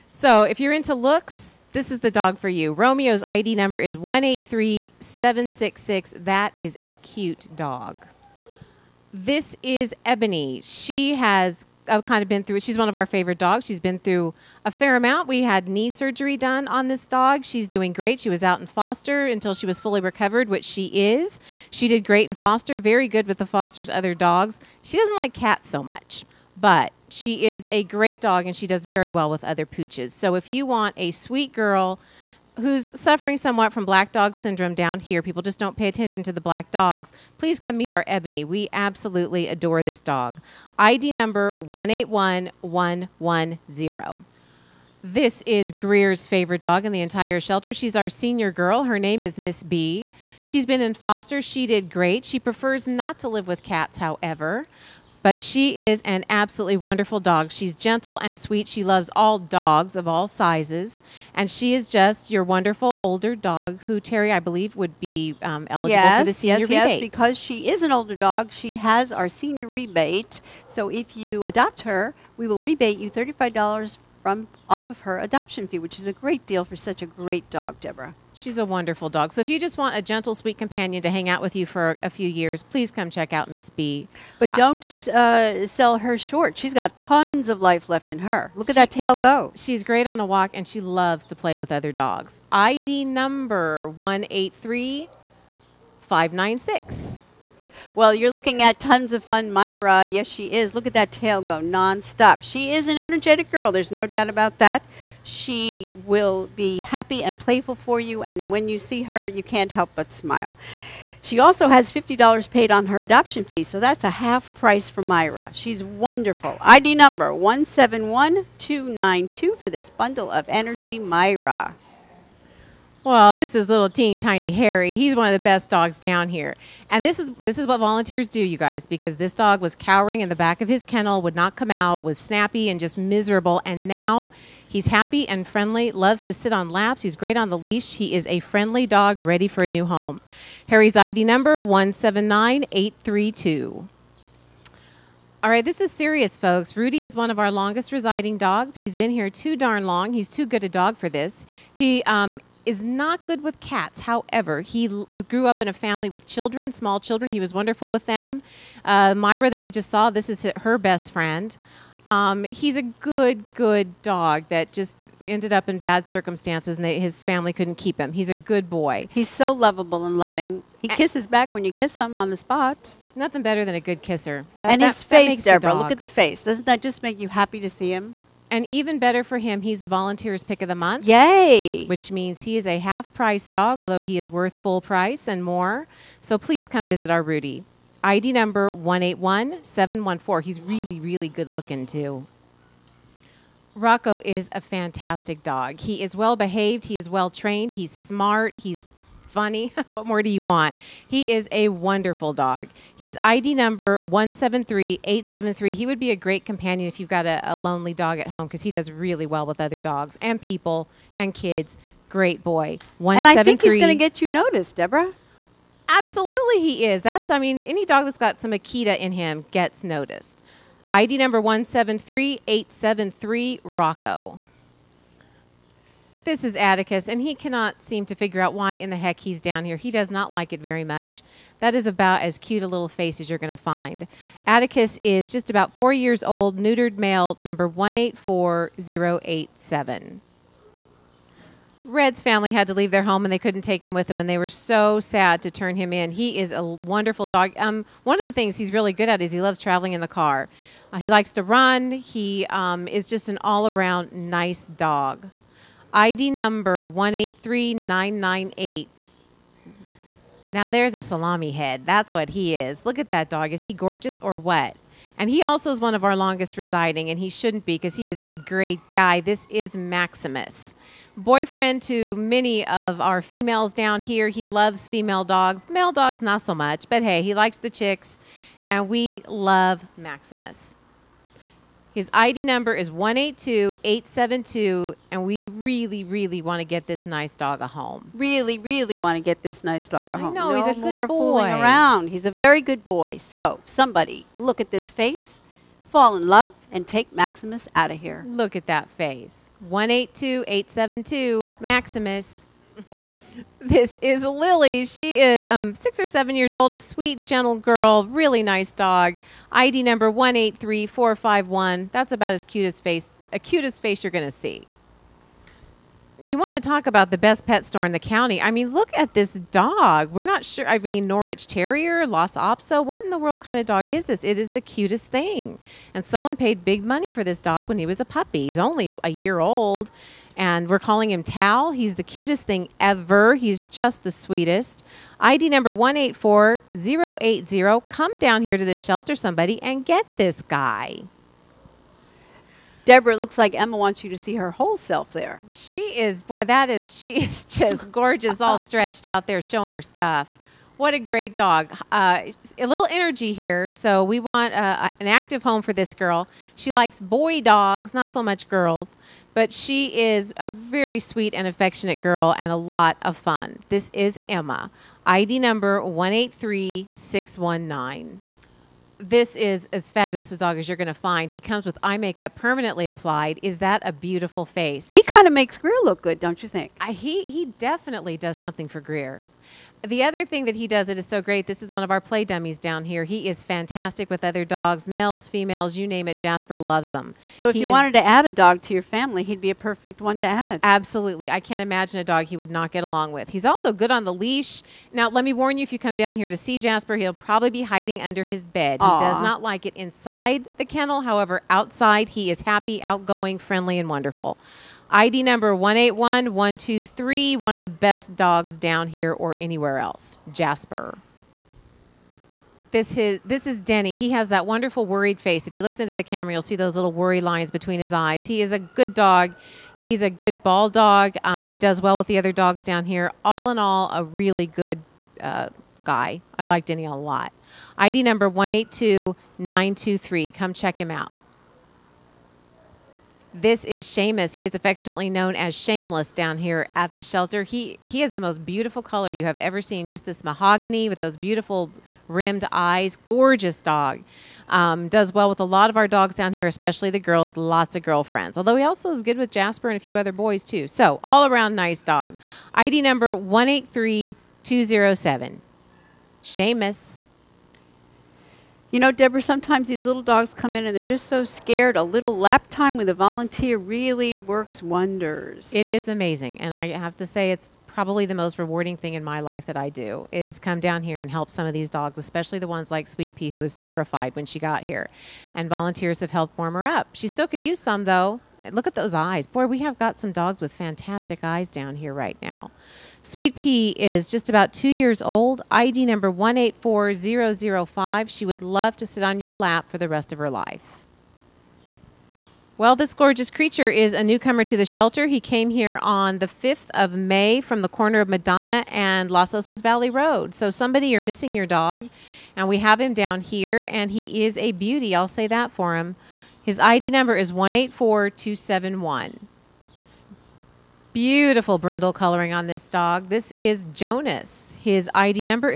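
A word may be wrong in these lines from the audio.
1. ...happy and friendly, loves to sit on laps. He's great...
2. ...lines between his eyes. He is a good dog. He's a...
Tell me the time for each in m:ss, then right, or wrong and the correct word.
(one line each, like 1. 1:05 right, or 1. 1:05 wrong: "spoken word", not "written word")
1. 2:14 right
2. 6:57 right.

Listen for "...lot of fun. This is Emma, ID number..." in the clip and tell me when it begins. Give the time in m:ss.
6:02.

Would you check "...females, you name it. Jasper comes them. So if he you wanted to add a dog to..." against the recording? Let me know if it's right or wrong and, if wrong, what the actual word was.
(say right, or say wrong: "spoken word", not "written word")
wrong: "loves", not "comes".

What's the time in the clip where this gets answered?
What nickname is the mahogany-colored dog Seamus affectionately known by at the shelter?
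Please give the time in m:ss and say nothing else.
7:15.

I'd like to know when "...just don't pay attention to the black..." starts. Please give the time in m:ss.
0:35.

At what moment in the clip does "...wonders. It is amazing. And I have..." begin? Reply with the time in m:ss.
7:44.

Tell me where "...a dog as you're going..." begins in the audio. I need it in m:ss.
6:10.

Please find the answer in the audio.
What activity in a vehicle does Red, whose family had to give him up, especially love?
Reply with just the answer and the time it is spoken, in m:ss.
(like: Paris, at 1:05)
Traveling in the car, at 4:09.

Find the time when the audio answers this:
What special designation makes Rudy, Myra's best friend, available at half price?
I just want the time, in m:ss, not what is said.
2:59.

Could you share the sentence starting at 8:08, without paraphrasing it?
She would love to sit on your lap for the rest of her life.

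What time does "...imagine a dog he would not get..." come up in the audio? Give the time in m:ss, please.
6:31.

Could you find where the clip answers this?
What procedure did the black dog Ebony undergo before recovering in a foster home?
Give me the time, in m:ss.
0:15.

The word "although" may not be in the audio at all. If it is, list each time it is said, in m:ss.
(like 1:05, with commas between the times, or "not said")
3:03, 7:28.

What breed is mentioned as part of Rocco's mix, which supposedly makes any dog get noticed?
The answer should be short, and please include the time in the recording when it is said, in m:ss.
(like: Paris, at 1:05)
Akita, at 3:38.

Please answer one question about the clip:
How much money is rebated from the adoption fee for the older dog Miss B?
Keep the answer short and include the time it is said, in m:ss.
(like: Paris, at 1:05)
$35, at 1:13.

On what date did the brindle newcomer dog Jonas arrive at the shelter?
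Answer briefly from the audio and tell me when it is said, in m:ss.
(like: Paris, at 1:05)
May 5, at 8:16.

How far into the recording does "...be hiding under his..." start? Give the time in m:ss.
6:37.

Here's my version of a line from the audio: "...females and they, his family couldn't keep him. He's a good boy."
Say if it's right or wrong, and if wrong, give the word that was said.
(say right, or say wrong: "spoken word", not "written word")
wrong: "circumstances", not "females".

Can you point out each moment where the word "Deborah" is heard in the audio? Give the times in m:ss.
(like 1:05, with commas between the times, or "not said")
1:17, 2:55, 3:34, 5:42, 7:38.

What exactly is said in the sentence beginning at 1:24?
But don't uh, sell her short.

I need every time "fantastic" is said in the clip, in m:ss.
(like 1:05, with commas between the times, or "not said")
3:14, 6:23, 8:00.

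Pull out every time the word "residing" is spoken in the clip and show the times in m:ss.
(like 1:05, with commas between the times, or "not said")
2:27, 4:26.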